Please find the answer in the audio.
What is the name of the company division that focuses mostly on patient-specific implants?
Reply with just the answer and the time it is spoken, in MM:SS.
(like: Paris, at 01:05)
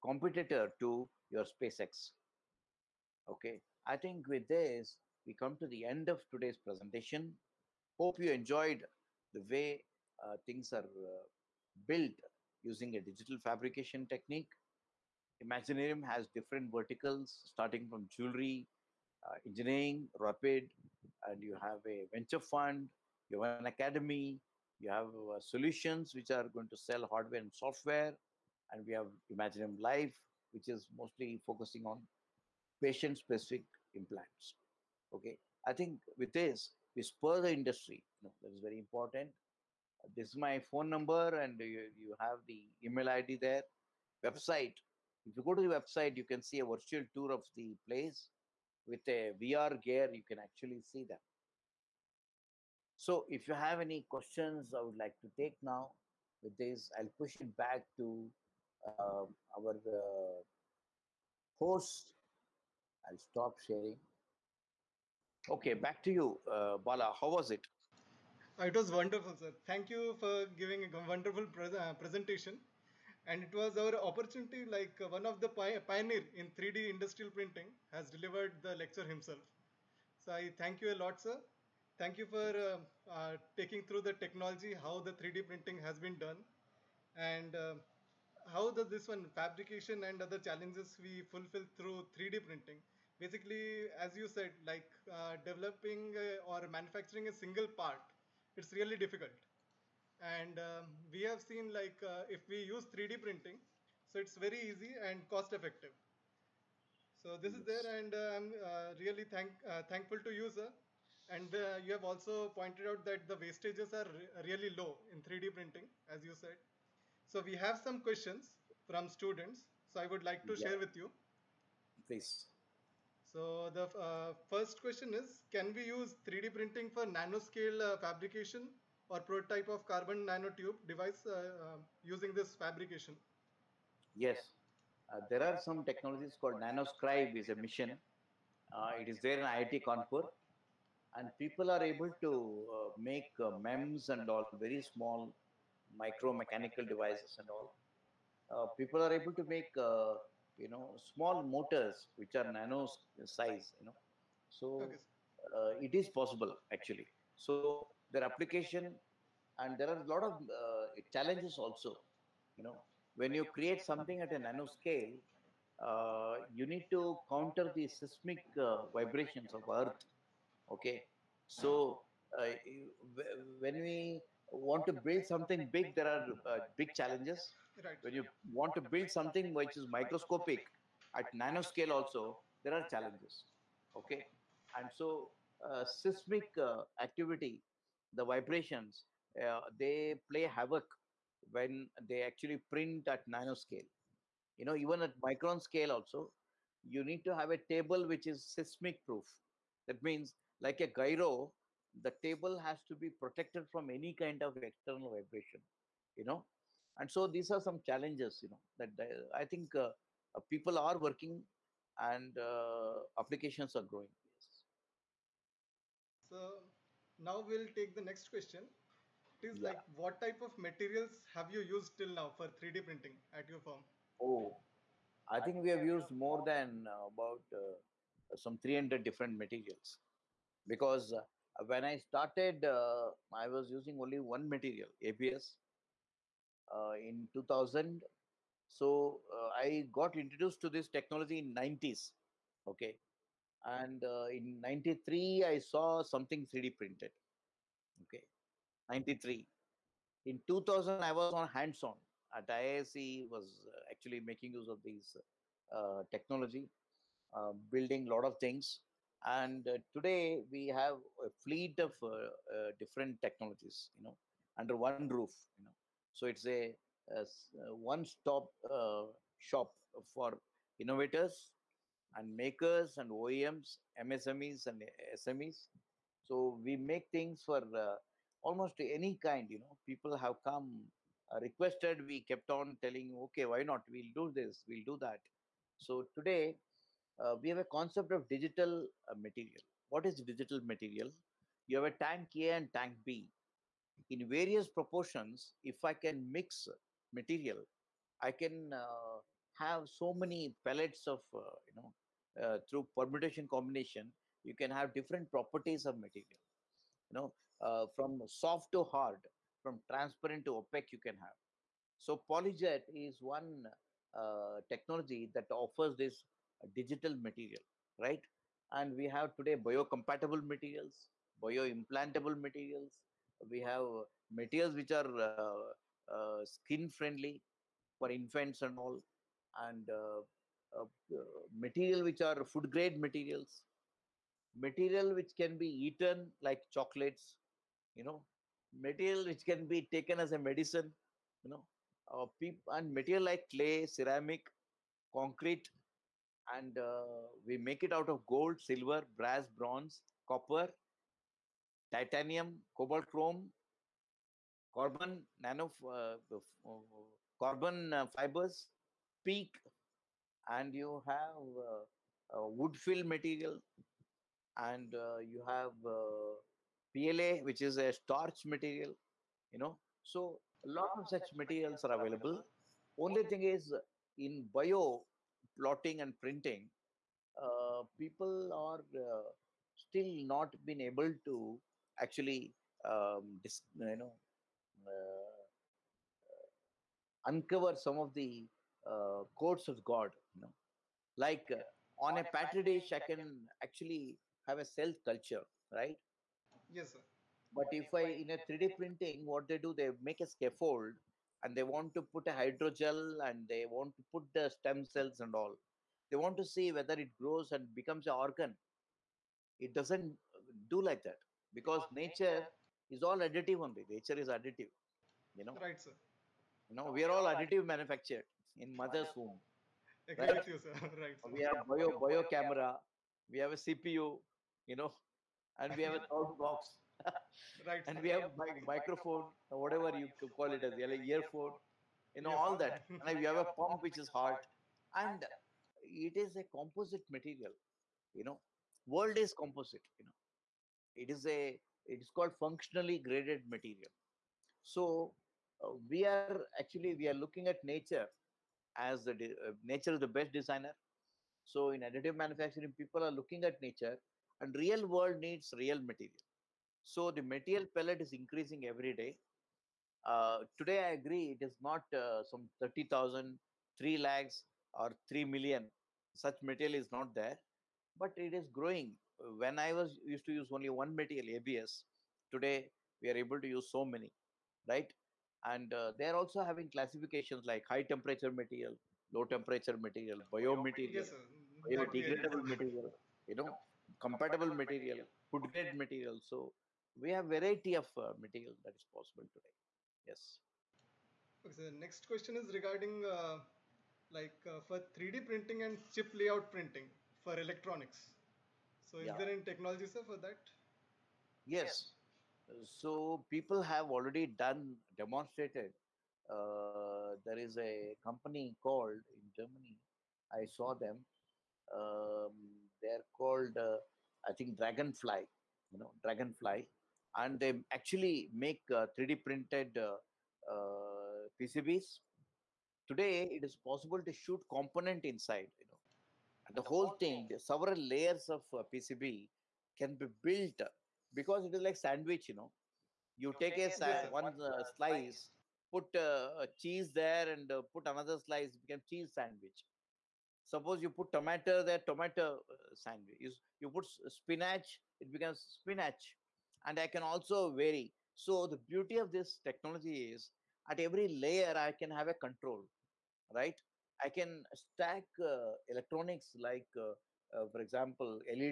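Imaginarium Life, at 00:29.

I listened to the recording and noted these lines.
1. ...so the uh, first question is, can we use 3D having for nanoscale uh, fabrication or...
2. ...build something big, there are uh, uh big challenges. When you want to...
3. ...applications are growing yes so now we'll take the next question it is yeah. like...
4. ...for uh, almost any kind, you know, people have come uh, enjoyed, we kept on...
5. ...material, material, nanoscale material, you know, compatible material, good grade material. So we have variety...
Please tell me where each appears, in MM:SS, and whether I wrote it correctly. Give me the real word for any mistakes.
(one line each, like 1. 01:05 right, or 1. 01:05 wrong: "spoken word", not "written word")
1. 02:03 wrong: "printing", not "having"
2. 02:54 right
3. 03:33 right
4. 04:37 wrong: "requested", not "enjoyed"
5. 07:59 wrong: "biodegradable", not "nanoscale".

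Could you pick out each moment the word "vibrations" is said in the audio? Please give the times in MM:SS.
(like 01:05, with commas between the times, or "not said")
02:48, 03:08, 03:25.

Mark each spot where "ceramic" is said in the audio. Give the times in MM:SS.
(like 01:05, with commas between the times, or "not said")
05:43.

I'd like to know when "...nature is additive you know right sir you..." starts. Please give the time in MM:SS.
06:53.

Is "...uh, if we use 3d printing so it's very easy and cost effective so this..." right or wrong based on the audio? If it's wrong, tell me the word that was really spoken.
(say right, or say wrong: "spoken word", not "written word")
right.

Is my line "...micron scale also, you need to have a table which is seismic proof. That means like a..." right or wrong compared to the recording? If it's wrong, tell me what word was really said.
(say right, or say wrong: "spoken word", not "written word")
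right.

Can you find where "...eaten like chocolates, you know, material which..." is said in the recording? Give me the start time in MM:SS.
05:35.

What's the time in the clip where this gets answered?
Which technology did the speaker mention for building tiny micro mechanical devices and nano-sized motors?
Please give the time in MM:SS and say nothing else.
02:16.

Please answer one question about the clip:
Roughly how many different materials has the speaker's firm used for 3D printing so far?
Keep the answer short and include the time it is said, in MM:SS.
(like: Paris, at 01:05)
300, at 03:48.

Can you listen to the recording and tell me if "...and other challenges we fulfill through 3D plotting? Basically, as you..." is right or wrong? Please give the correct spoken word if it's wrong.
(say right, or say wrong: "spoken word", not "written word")
wrong: "printing", not "plotting".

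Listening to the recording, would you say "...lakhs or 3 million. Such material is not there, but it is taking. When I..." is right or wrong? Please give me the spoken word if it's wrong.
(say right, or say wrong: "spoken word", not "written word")
wrong: "growing", not "taking".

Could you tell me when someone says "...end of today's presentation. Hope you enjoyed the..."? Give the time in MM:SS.
00:05.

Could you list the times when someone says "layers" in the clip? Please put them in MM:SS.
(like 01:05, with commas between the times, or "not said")
08:47, 09:11.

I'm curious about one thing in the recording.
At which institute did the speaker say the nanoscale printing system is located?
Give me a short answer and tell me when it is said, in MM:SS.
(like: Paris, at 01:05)
IIT Kanpur, at 02:19.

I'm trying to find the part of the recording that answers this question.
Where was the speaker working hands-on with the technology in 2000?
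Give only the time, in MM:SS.
04:12.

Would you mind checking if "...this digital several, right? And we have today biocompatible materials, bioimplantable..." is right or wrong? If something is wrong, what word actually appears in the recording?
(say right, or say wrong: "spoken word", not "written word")
wrong: "material", not "several".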